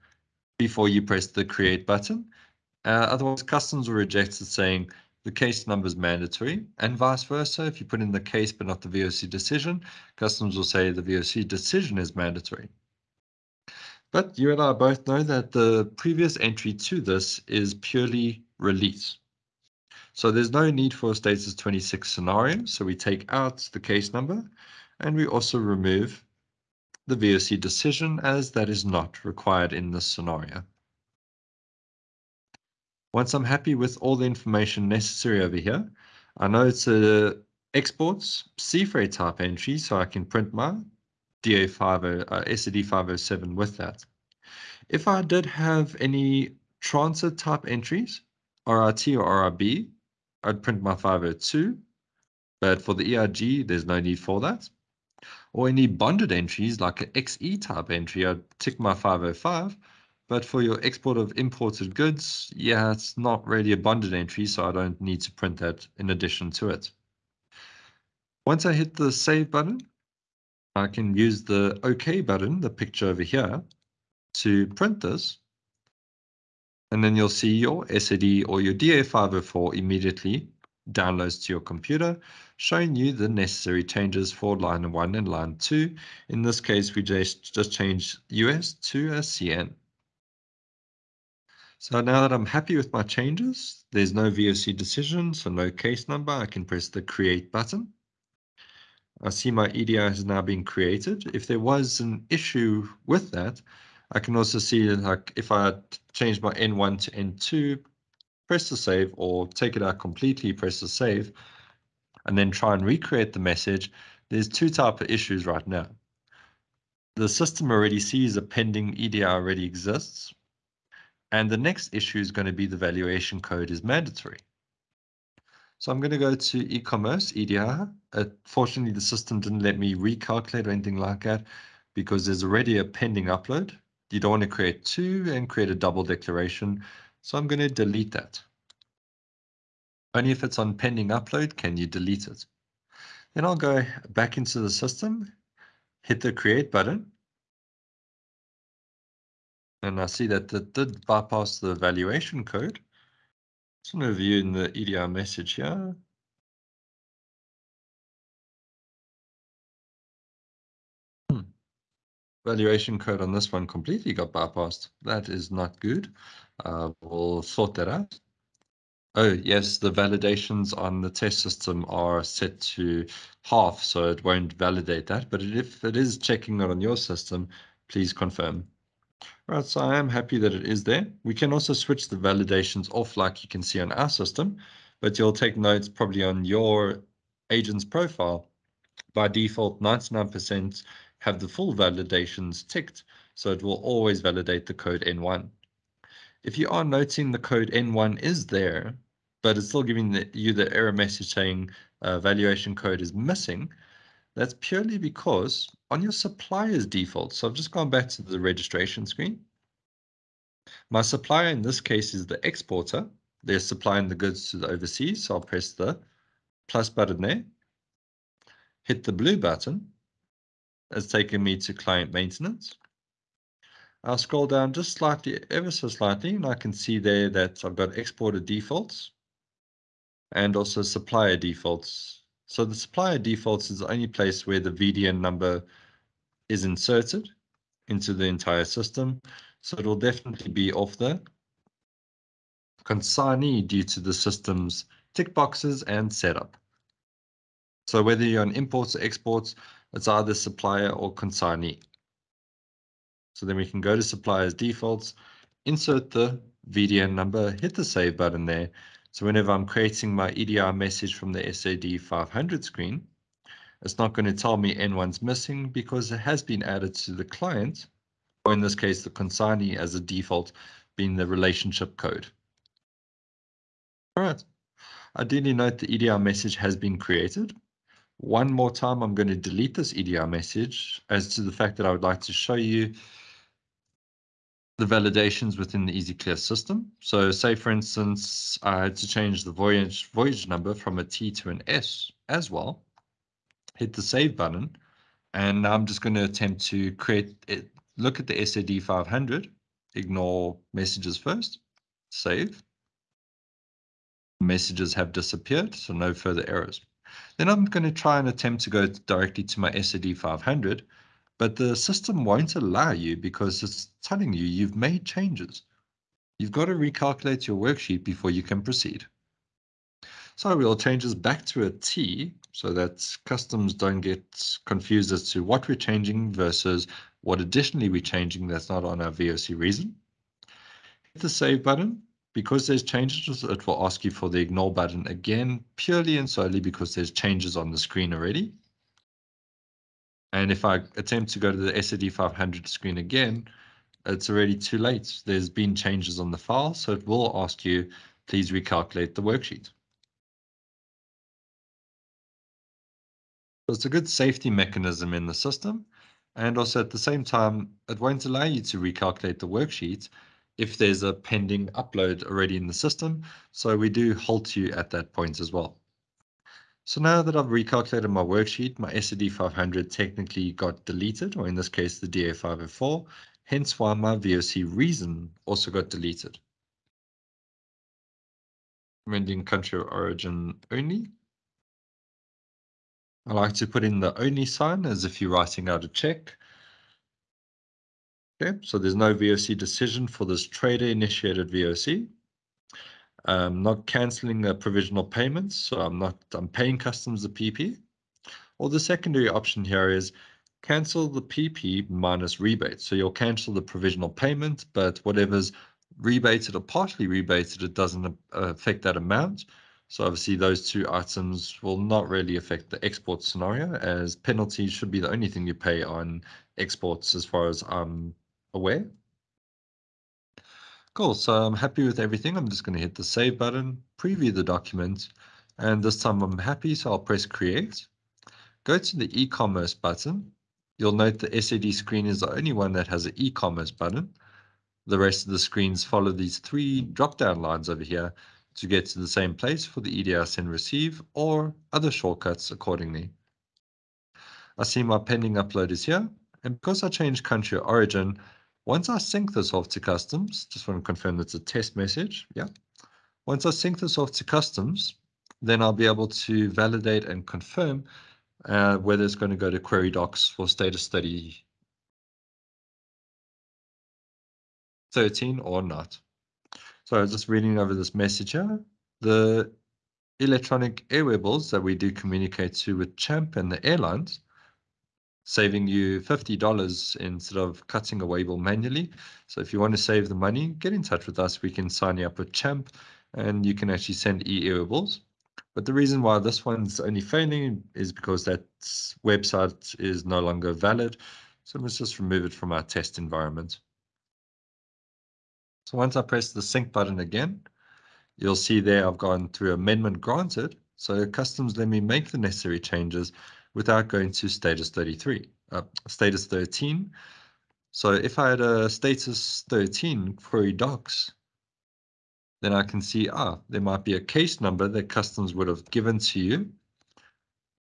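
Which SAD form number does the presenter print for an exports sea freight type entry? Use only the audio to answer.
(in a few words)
507.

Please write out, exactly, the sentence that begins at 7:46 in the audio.
So I was just reading over this message here.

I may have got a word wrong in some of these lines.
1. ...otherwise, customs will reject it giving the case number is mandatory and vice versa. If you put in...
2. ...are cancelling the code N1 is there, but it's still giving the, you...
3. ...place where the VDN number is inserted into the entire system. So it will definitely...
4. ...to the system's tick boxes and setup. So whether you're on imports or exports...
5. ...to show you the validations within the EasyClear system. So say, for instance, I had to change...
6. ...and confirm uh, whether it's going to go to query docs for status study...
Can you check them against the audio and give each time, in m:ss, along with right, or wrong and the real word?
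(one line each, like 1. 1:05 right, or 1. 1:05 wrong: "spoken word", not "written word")
1. 0:03 wrong: "saying", not "giving"
2. 3:16 wrong: "noting", not "cancelling"
3. 3:54 right
4. 4:03 right
5. 4:42 right
6. 7:37 right.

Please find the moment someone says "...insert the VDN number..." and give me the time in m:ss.
4:15.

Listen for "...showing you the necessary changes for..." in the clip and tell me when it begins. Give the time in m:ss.
1:22.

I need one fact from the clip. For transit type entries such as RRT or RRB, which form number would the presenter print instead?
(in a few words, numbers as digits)
502.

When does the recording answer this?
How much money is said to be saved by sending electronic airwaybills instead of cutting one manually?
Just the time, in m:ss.
7:56.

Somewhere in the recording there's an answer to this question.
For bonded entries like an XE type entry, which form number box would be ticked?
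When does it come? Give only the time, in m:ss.
0:58.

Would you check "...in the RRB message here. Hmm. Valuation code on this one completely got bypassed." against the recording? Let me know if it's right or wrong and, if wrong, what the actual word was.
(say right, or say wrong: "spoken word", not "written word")
wrong: "EDR", not "RRB".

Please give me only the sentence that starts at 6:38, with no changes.
Or the secondary option here is cancel the PP minus rebate.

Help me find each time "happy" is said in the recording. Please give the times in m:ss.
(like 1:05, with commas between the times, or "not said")
0:33, 1:32, 3:00, 7:01, 7:06.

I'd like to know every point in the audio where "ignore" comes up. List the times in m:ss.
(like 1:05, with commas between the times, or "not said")
4:59, 5:34.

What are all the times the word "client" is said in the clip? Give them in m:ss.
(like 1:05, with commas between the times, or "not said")
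3:41, 4:27.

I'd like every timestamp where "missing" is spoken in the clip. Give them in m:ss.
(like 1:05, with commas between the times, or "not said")
3:23, 4:25.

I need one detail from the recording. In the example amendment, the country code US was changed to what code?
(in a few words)
CN.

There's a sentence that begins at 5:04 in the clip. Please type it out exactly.
Messages have disappeared, so no further errors.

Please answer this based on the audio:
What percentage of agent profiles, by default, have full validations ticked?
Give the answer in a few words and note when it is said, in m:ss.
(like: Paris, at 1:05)
99%, at 3:09.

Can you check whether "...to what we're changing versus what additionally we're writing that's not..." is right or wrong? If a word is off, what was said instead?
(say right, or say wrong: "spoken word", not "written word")
wrong: "changing", not "writing".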